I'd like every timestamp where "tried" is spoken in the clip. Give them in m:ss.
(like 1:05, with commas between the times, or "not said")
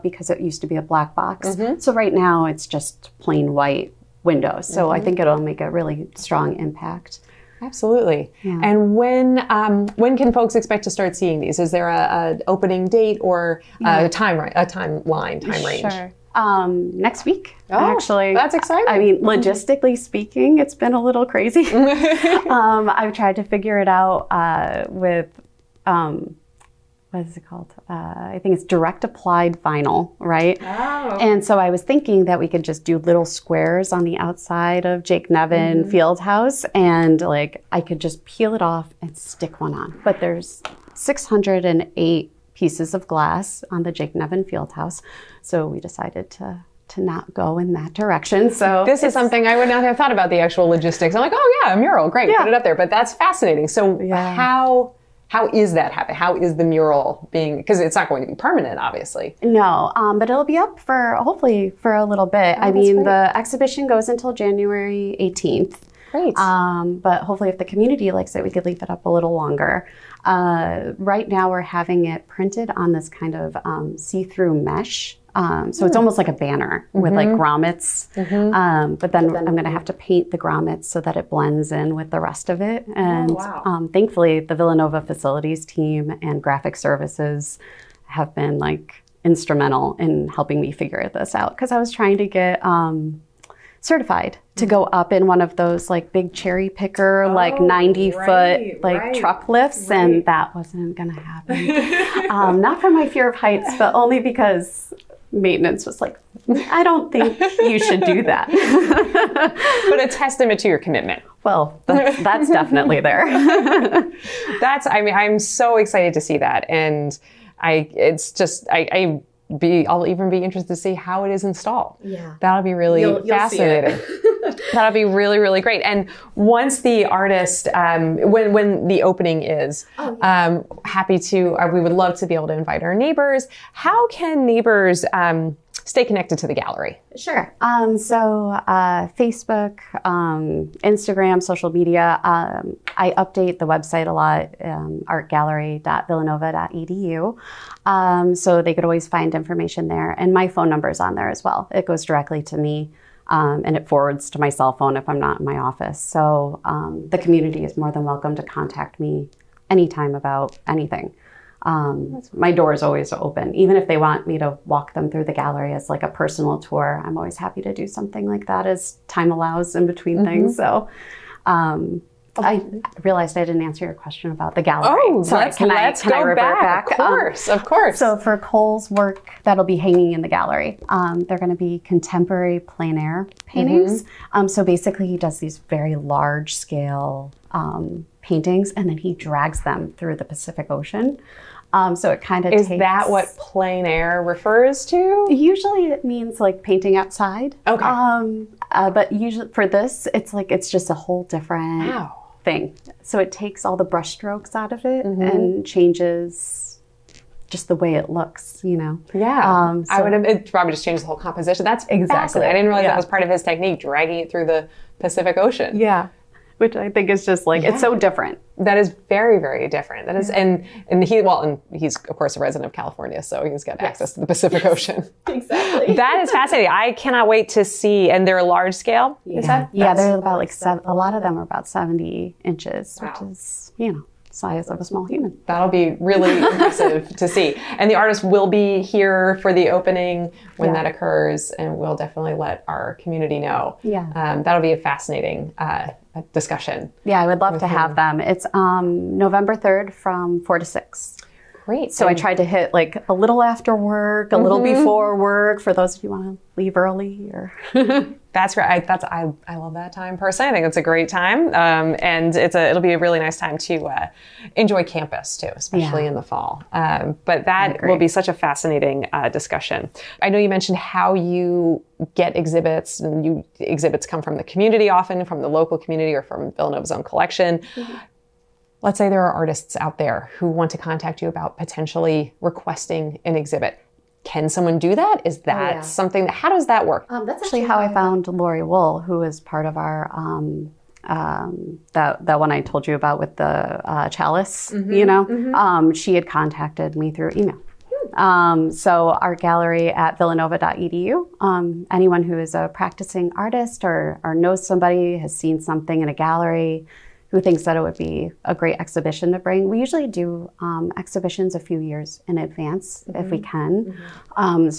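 0:23, 4:12.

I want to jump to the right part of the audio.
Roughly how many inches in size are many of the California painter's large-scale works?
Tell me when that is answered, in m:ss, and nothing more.
3:51.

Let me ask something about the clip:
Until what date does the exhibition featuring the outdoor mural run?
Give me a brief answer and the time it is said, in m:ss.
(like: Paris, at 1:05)
January 18th, at 1:04.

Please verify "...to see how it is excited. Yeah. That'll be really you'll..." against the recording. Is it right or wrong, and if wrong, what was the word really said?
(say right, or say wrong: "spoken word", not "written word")
wrong: "installed", not "excited".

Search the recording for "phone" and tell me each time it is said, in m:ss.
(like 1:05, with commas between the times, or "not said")
2:30, 2:34.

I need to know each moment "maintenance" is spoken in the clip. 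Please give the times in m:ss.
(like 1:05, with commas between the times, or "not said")
1:45.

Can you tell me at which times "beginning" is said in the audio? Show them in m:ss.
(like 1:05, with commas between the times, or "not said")
not said.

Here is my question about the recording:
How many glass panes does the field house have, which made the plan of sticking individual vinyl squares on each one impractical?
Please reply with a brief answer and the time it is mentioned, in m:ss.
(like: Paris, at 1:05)
608, at 0:40.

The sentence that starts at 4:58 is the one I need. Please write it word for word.
Um, so our gallery at villanova.edu.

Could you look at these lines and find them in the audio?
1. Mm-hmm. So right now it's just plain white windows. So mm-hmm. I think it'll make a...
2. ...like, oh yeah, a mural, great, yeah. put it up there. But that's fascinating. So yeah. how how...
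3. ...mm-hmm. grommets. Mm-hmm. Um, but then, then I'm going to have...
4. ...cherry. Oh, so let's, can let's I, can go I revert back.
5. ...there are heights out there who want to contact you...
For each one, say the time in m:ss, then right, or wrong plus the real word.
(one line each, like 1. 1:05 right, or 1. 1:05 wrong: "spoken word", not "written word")
1. 0:01 right
2. 0:51 right
3. 1:17 right
4. 2:54 wrong: "gallery", not "cherry"
5. 4:39 wrong: "artists", not "heights".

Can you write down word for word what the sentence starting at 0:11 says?
Is there a, a opening date or yeah.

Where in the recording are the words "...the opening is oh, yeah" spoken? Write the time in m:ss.
2:08.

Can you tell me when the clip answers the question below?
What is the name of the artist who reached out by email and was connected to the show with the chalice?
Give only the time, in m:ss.
4:48.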